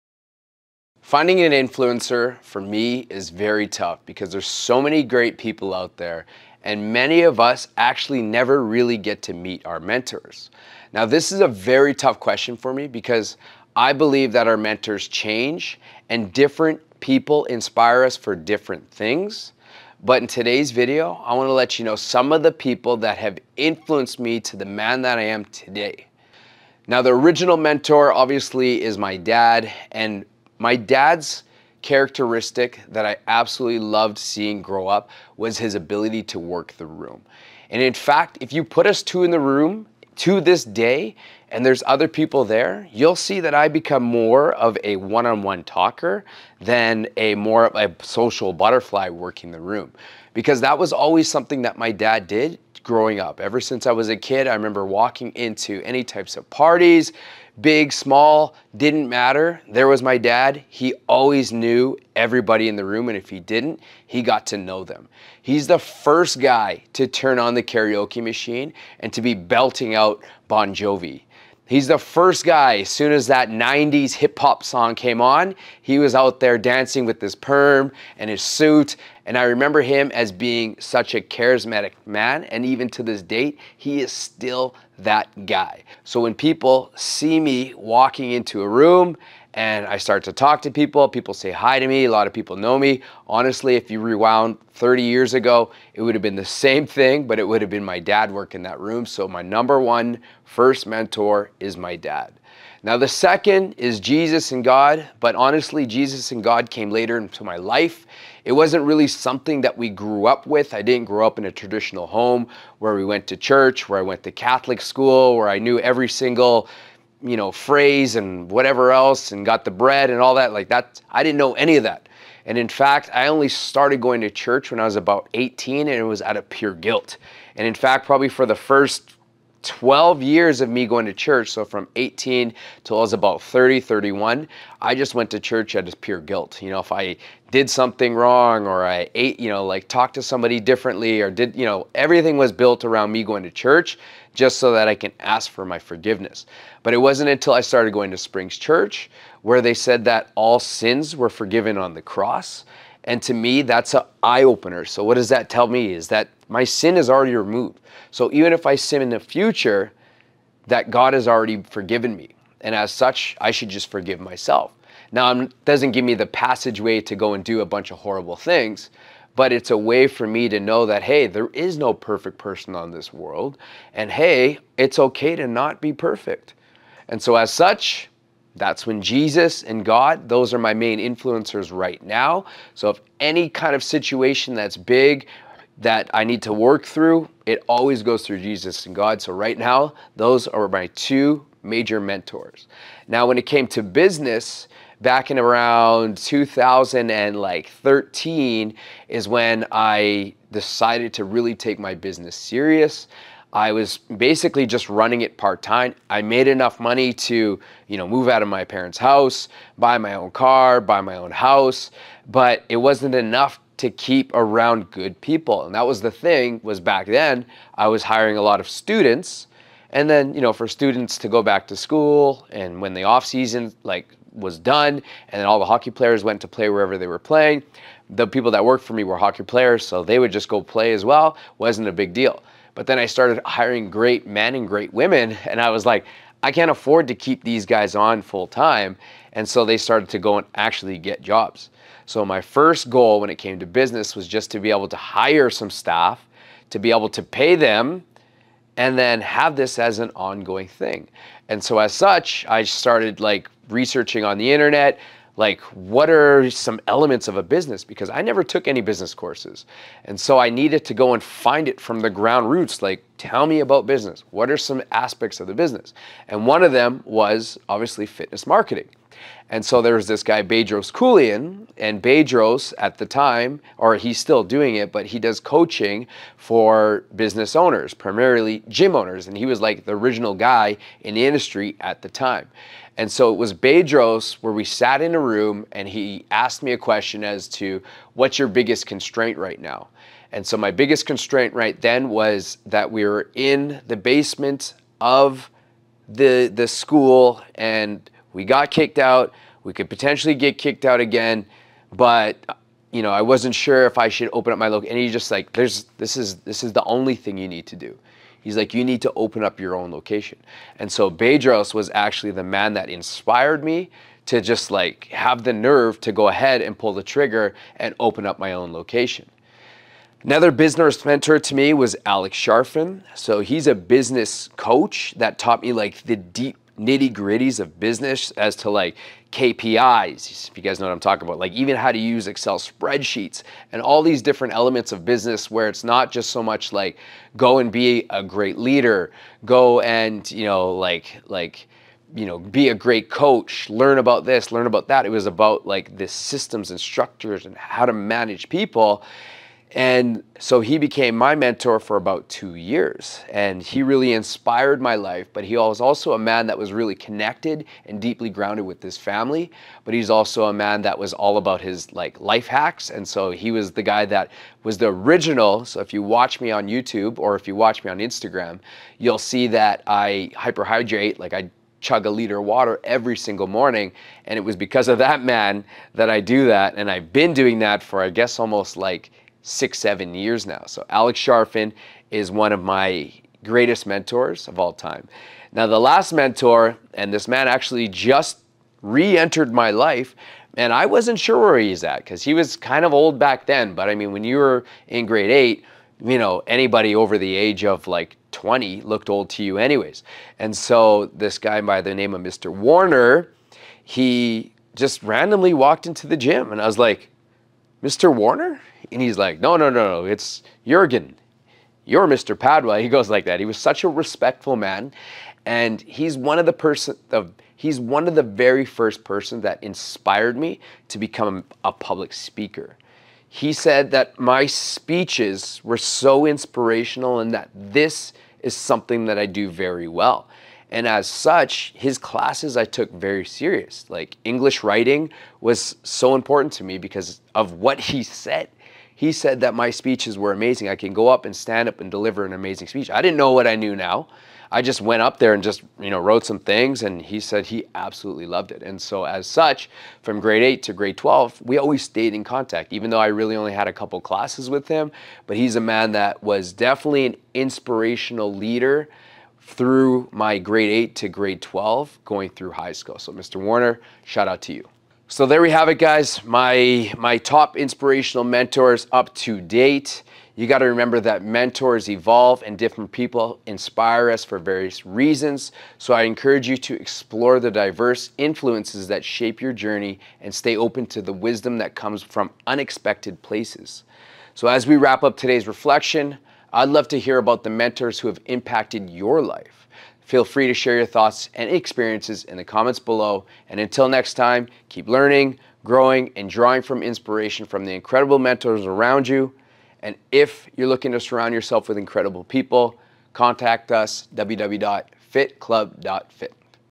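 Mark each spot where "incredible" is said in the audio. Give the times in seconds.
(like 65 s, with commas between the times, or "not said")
497 s, 501 s.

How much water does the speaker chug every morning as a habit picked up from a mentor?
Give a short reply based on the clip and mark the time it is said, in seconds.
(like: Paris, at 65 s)
A liter, at 372 s.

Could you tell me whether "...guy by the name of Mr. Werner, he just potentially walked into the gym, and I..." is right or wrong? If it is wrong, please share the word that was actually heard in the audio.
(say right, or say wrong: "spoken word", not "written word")
wrong: "randomly", not "potentially".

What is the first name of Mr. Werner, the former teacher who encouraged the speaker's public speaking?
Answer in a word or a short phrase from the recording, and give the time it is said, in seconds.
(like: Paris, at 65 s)
Jurgen, at 410 s.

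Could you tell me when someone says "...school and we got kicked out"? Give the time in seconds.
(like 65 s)
296 s.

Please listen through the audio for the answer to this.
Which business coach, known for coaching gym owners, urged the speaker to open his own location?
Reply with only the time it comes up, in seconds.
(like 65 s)
270 s.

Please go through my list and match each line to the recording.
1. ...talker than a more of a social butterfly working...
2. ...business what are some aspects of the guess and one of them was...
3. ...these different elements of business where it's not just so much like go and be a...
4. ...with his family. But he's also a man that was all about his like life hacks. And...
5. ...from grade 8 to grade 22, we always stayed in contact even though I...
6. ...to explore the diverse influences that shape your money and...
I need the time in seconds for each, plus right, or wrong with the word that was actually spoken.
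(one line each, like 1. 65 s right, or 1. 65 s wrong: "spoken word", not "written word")
1. 45 s right
2. 263 s wrong: "business", not "guess"
3. 334 s right
4. 358 s right
5. 450 s wrong: "12", not "22"
6. 476 s wrong: "journey", not "money".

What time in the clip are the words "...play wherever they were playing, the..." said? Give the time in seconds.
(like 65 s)
226 s.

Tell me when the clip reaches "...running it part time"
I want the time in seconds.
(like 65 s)
204 s.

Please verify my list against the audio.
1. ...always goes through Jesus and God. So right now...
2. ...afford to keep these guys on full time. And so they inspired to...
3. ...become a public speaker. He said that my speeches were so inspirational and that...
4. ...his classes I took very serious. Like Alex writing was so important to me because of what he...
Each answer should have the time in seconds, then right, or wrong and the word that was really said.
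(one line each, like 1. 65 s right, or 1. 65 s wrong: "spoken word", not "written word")
1. 187 s right
2. 236 s wrong: "started", not "inspired"
3. 420 s right
4. 431 s wrong: "English", not "Alex".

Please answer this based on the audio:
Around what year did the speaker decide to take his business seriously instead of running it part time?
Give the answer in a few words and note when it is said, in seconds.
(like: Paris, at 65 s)
2013, at 196 s.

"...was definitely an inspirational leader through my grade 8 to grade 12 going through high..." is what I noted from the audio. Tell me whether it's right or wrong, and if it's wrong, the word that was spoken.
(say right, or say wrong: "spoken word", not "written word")
right.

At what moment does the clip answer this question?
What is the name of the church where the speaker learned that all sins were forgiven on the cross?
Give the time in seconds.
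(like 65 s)
148 s.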